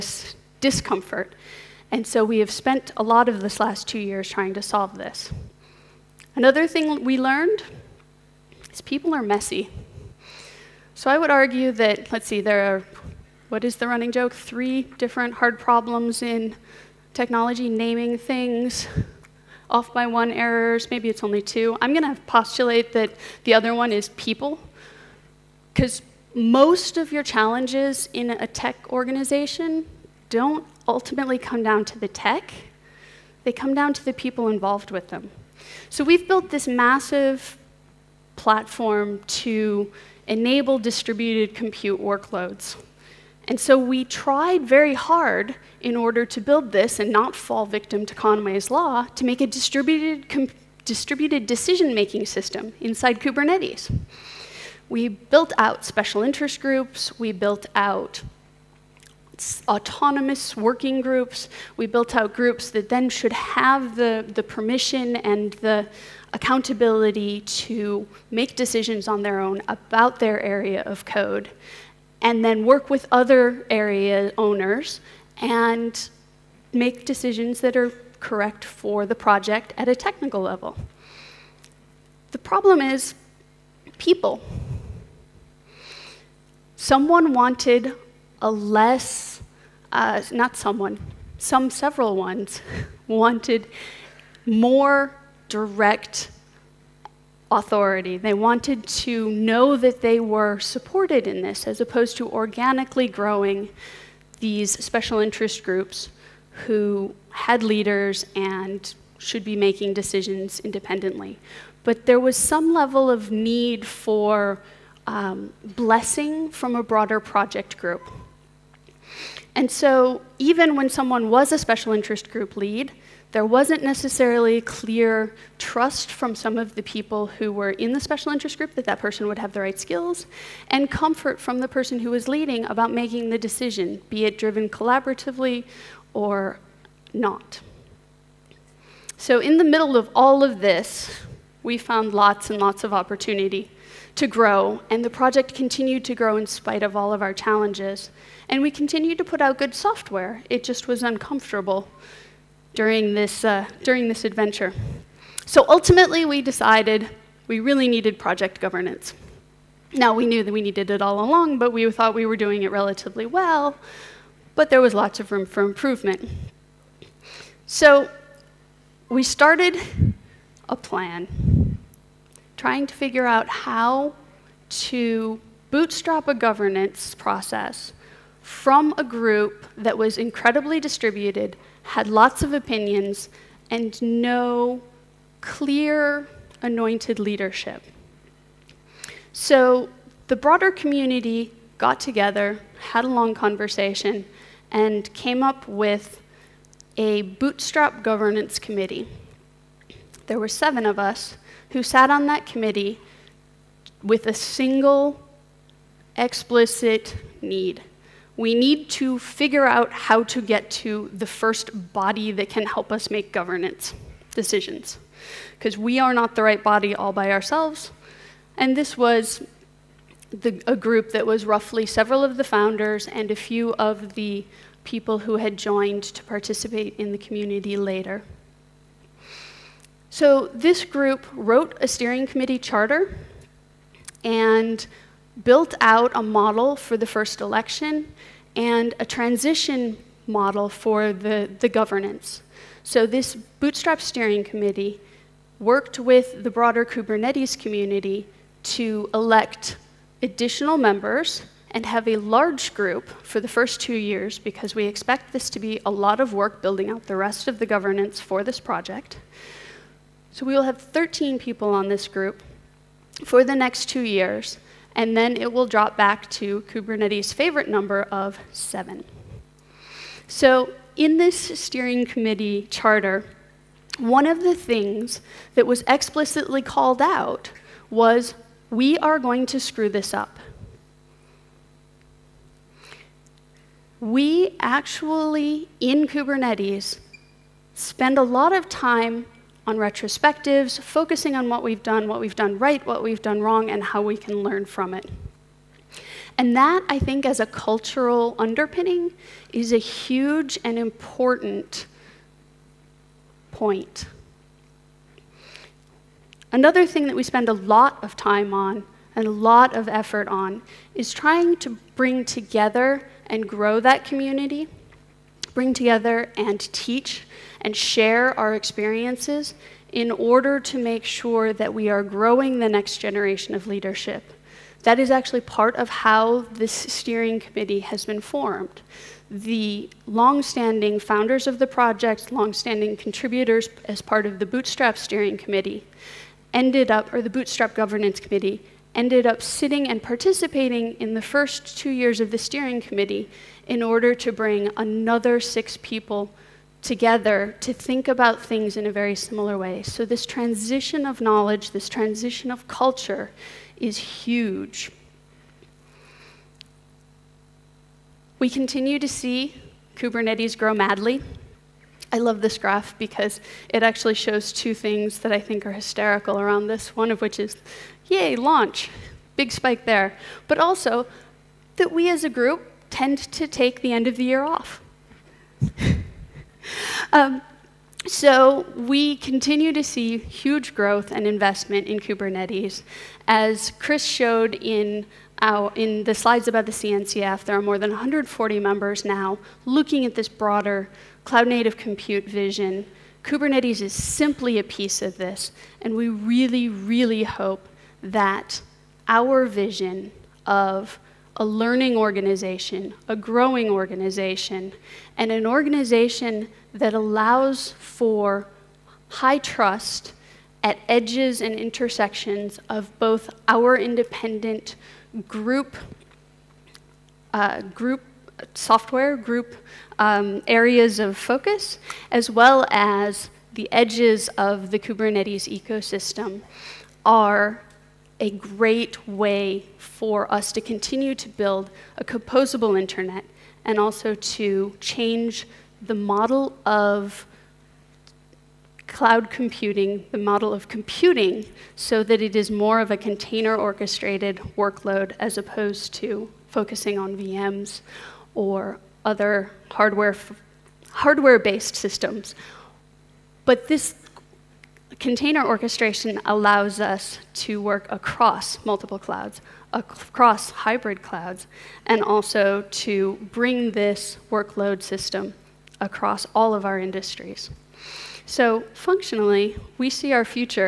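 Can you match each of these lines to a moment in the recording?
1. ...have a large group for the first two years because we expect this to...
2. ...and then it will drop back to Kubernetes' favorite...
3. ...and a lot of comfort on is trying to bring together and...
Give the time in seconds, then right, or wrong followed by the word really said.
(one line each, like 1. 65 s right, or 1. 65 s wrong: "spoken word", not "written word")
1. 251 s right
2. 264 s right
3. 309 s wrong: "effort", not "comfort".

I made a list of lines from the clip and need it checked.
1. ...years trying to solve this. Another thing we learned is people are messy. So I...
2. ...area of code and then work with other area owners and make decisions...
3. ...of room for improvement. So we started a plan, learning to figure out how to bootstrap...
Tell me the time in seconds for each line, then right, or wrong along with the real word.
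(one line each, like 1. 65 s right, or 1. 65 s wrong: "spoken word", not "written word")
1. 3 s right
2. 70 s right
3. 165 s wrong: "trying", not "learning".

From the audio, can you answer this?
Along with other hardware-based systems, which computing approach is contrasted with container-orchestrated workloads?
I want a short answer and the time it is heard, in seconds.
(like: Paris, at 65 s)
VMs, at 447 s.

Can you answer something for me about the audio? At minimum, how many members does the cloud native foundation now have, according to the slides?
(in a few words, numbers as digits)
More than 140.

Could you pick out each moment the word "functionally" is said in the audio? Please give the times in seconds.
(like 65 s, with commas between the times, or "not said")
468 s.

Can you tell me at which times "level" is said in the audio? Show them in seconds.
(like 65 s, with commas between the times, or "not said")
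80 s, 112 s.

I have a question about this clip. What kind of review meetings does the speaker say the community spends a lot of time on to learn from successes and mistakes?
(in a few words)
Retrospectives.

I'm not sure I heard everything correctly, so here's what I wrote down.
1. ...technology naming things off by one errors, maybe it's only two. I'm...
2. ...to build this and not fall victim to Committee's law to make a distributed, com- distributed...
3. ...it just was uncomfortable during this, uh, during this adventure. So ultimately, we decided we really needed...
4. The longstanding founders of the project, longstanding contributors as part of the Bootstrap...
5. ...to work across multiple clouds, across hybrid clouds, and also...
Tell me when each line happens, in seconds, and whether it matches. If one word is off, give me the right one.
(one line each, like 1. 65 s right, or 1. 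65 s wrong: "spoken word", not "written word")
1. 17 s right
2. 46 s wrong: "Conway", not "Committee"
3. 150 s right
4. 329 s right
5. 457 s right.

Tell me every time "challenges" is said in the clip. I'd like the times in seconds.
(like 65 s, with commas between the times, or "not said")
27 s, 147 s.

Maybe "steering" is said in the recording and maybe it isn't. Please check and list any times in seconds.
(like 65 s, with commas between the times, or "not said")
231 s, 243 s, 271 s, 326 s, 334 s, 342 s.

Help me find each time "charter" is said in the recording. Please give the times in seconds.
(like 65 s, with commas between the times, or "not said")
232 s, 272 s.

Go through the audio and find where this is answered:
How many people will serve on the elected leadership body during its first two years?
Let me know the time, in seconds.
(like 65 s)
260 s.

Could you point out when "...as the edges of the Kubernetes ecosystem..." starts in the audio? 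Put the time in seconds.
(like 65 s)
422 s.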